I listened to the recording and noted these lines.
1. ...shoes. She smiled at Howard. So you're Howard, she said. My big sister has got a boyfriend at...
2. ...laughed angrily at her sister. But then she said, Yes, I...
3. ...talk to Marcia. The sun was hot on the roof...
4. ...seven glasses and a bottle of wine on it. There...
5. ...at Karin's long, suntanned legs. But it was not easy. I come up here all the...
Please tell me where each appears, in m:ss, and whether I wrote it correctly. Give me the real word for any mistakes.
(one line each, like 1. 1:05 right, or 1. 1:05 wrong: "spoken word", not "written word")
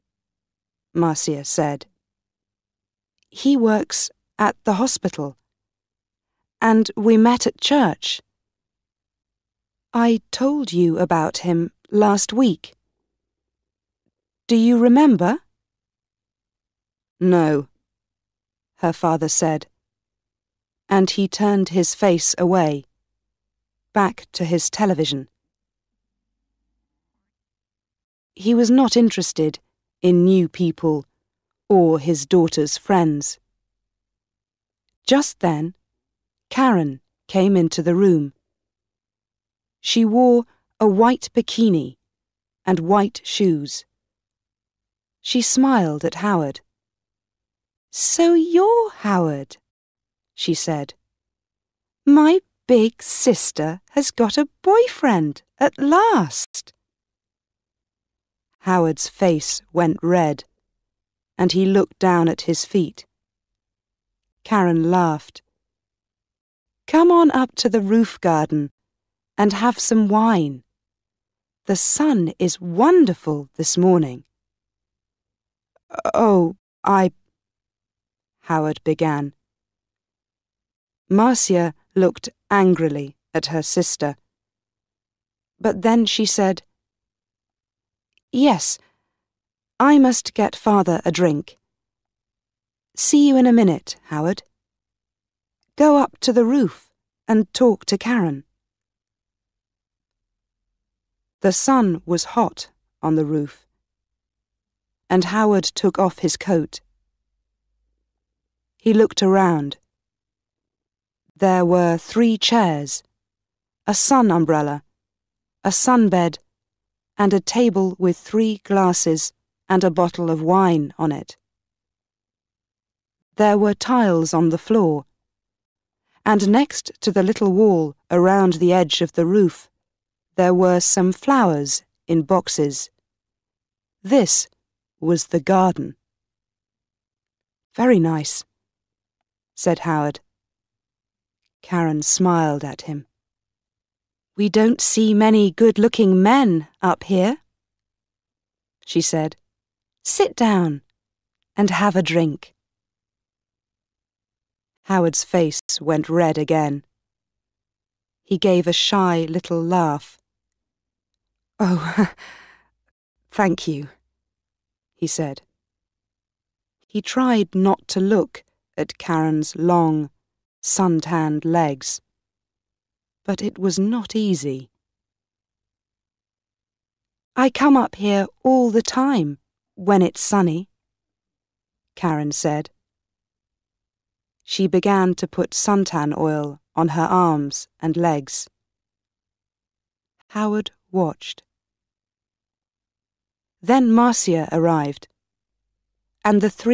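1. 0:43 right
2. 1:21 wrong: "looked", not "laughed"
3. 1:37 wrong: "Karin", not "Marcia"
4. 1:58 wrong: "three", not "seven"
5. 2:48 right.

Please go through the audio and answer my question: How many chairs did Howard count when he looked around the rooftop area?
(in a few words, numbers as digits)
3.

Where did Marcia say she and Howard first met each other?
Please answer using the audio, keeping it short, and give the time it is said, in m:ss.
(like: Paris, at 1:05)
church, at 0:07.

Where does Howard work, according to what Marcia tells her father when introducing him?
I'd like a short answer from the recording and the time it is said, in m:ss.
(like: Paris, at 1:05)
the hospital, at 0:04.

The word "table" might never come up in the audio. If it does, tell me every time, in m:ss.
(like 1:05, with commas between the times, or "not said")
1:57.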